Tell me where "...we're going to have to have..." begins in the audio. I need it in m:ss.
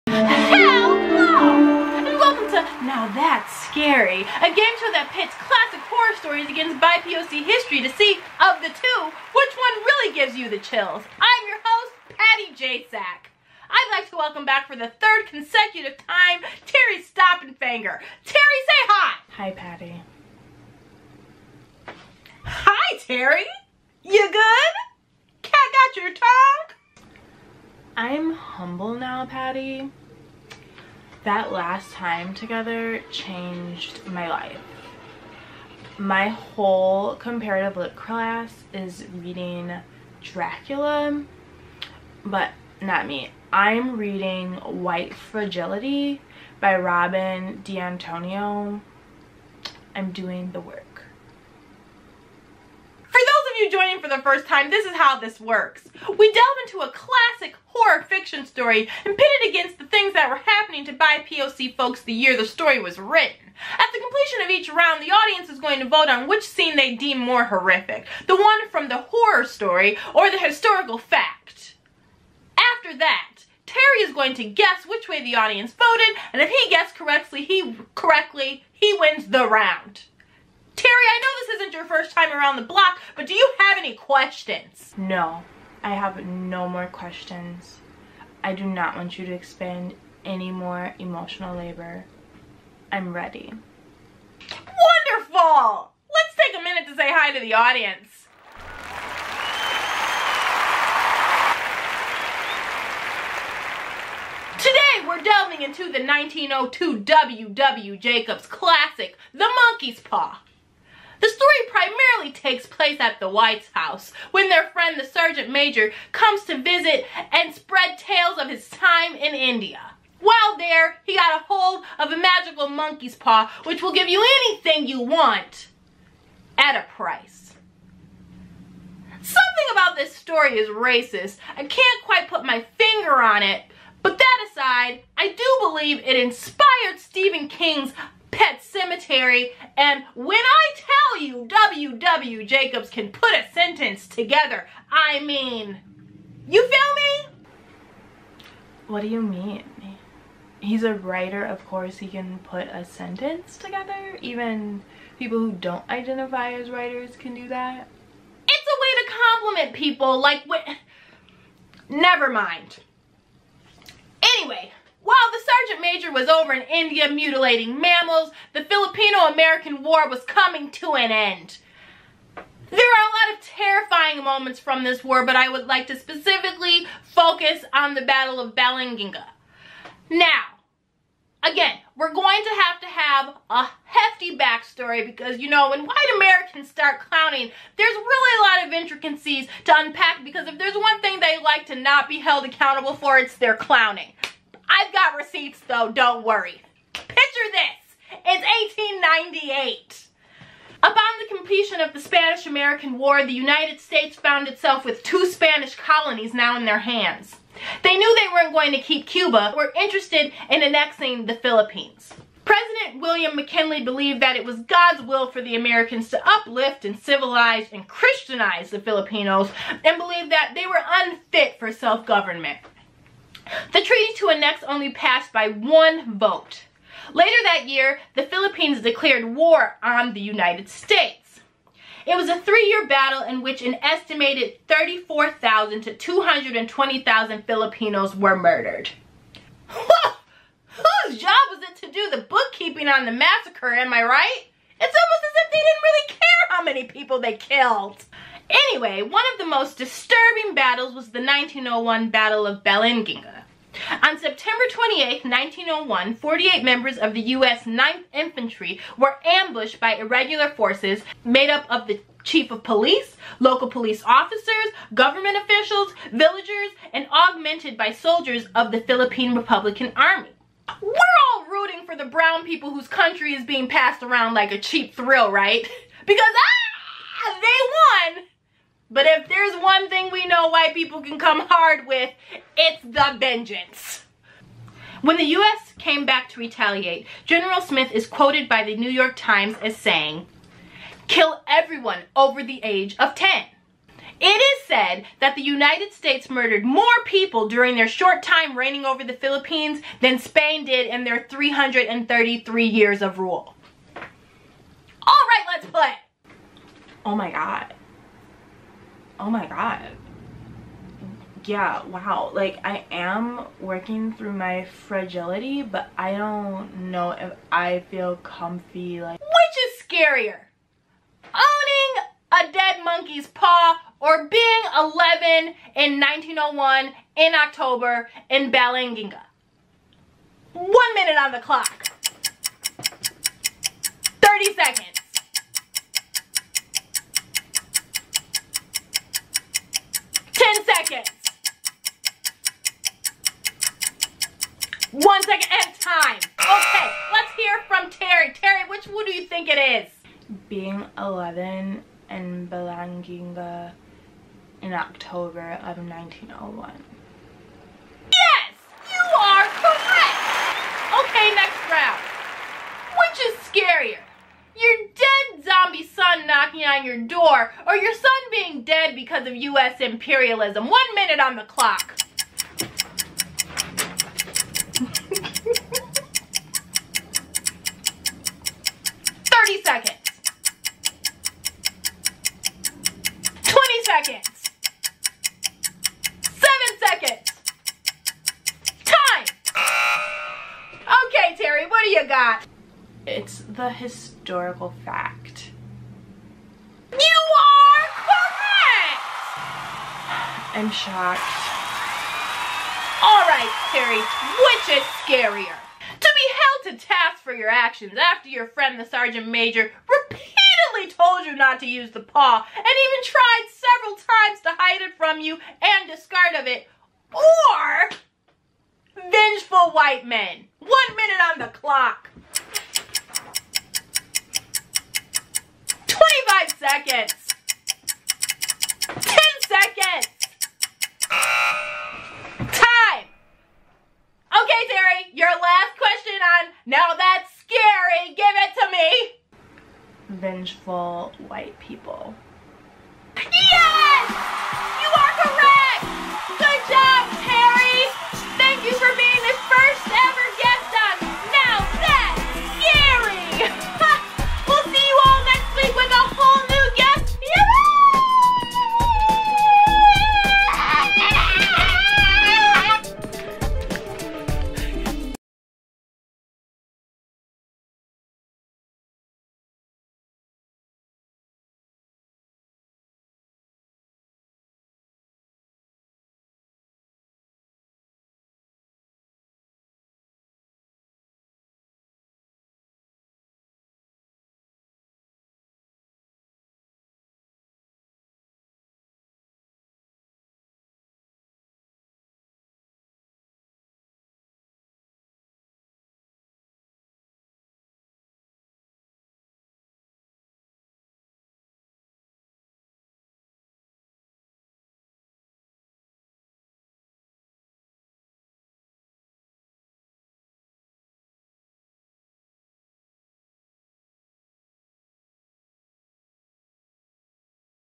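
3:01.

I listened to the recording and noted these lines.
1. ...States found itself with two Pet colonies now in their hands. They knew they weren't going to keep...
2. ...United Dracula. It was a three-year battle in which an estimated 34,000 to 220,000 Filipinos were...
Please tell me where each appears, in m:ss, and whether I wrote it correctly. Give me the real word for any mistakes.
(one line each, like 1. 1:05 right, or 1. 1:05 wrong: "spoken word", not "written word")
1. 3:23 wrong: "Spanish", not "Pet"
2. 3:50 wrong: "States", not "Dracula".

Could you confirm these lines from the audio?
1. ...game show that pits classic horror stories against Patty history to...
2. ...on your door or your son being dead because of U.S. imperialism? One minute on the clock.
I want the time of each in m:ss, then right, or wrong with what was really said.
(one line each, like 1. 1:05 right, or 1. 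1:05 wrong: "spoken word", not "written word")
1. 0:04 wrong: "BIPOC", not "Patty"
2. 6:06 right.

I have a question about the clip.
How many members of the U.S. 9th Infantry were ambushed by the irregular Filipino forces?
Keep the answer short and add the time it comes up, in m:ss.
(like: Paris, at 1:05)
48, at 4:16.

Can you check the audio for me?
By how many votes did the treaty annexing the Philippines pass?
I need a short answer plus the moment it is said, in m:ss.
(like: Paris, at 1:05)
1, at 3:45.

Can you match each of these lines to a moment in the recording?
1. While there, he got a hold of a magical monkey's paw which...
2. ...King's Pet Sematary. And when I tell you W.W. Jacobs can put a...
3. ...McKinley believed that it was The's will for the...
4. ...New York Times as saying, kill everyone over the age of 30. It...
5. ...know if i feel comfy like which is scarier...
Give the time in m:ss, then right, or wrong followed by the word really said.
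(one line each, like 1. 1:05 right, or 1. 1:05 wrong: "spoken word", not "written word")
1. 2:00 right
2. 2:17 right
3. 3:33 wrong: "God", not "The"
4. 4:48 wrong: "10", not "30"
5. 5:16 right.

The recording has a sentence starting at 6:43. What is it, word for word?
All right, Sherry, which is scarier?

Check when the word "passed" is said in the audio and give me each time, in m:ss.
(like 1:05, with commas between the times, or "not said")
3:44, 4:33.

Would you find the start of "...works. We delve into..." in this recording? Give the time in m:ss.
0:55.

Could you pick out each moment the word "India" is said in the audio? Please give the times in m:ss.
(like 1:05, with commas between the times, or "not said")
1:59, 2:46.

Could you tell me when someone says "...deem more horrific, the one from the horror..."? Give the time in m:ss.
1:06.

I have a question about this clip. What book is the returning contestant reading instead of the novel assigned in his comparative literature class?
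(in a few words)
White Fragility.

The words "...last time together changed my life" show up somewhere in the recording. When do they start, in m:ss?
0:31.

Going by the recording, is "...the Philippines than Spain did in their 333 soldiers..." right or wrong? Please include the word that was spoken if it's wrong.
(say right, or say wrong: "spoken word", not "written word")
wrong: "years", not "soldiers".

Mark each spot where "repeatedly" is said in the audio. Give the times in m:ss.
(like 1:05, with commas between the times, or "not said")
6:49.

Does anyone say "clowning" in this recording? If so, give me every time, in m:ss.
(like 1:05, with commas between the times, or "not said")
3:07, 3:13.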